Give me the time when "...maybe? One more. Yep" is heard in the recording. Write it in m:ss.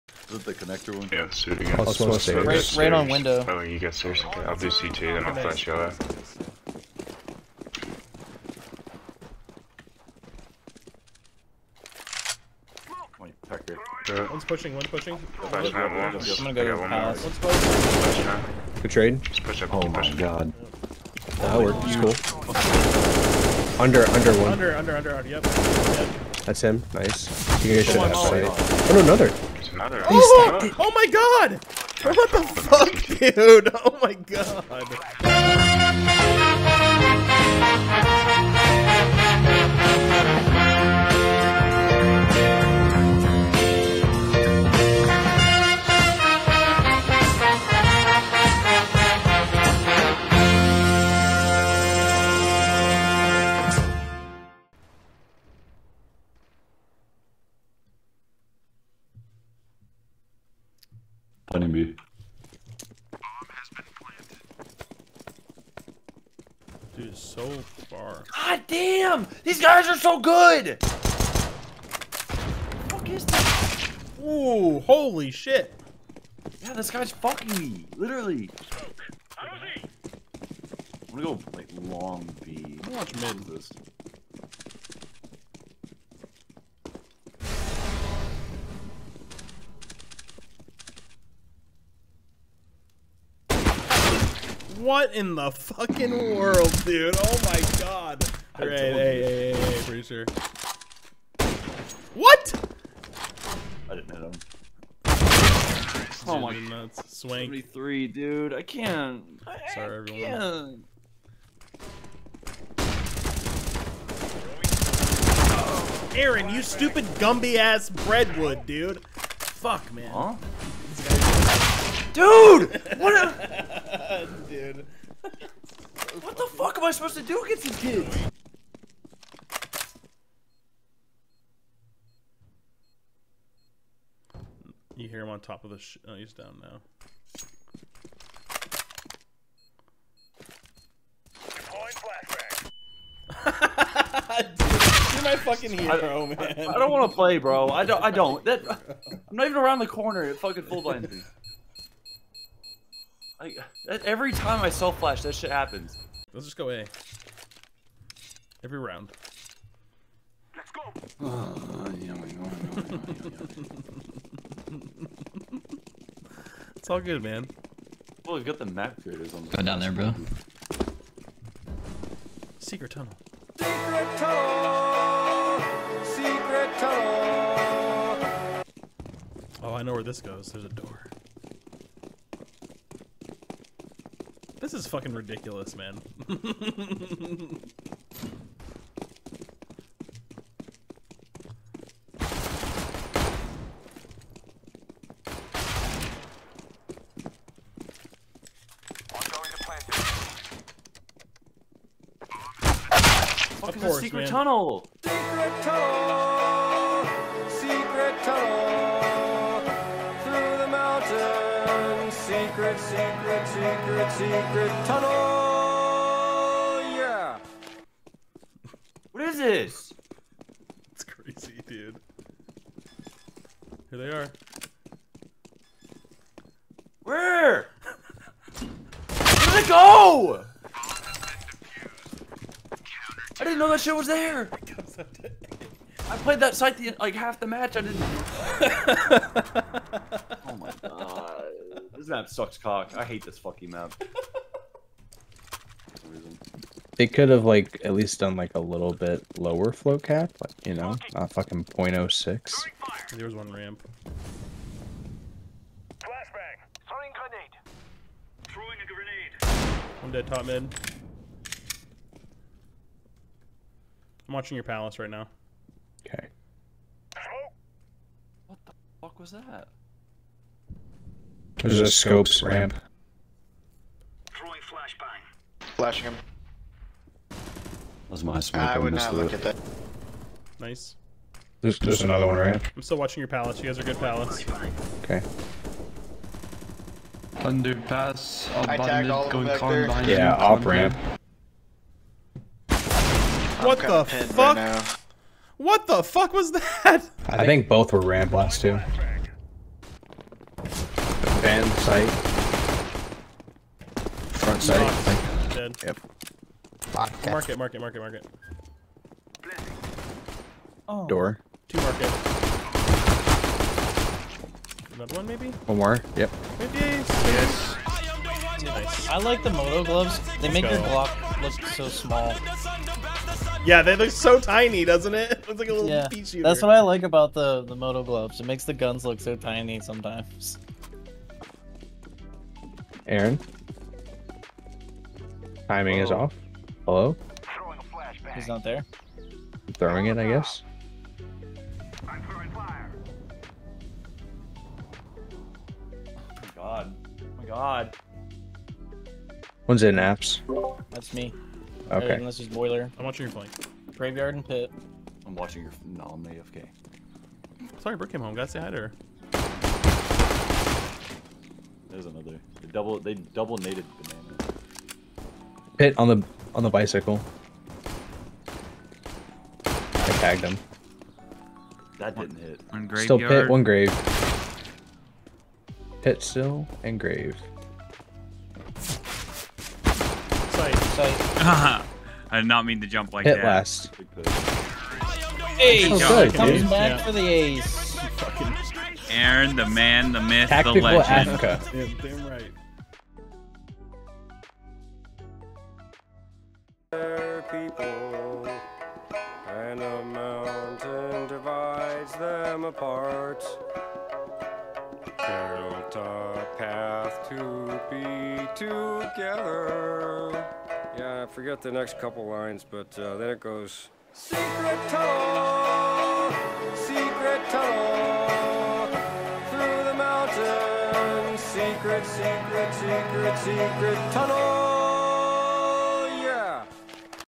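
5:15.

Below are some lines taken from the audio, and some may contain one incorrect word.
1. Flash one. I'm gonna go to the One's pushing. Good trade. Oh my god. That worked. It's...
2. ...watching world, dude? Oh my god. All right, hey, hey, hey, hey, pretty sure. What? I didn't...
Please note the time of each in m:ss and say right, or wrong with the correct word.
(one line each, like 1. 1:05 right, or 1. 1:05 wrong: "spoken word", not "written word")
1. 0:15 right
2. 1:35 wrong: "fucking", not "watching".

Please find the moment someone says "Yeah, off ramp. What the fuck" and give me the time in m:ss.
4:50.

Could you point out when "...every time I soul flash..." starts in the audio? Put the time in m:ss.
2:34.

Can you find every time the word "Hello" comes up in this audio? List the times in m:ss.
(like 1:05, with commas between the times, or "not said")
5:36.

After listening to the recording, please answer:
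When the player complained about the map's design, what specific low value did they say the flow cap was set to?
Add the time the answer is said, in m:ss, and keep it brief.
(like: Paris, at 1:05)
0.06, at 4:11.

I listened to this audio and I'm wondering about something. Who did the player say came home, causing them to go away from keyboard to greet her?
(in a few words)
Brooke.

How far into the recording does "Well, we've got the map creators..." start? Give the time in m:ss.
2:48.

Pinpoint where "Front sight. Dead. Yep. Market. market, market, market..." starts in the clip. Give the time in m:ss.
5:04.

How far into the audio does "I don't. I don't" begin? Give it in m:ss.
2:27.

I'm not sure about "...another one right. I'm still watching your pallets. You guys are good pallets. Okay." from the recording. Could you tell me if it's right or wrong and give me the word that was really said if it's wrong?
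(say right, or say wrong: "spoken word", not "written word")
right.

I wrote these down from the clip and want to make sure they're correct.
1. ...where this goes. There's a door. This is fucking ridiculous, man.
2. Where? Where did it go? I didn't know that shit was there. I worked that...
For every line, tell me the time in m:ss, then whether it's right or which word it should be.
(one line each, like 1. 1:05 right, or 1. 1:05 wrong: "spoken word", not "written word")
1. 2:59 right
2. 3:47 wrong: "played", not "worked".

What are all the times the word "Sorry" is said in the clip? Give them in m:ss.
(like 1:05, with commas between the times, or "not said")
1:49, 5:57.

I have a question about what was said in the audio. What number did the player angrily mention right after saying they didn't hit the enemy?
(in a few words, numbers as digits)
73.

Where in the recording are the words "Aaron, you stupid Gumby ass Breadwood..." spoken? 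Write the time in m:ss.
1:56.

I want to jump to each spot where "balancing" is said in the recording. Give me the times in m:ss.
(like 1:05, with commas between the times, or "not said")
not said.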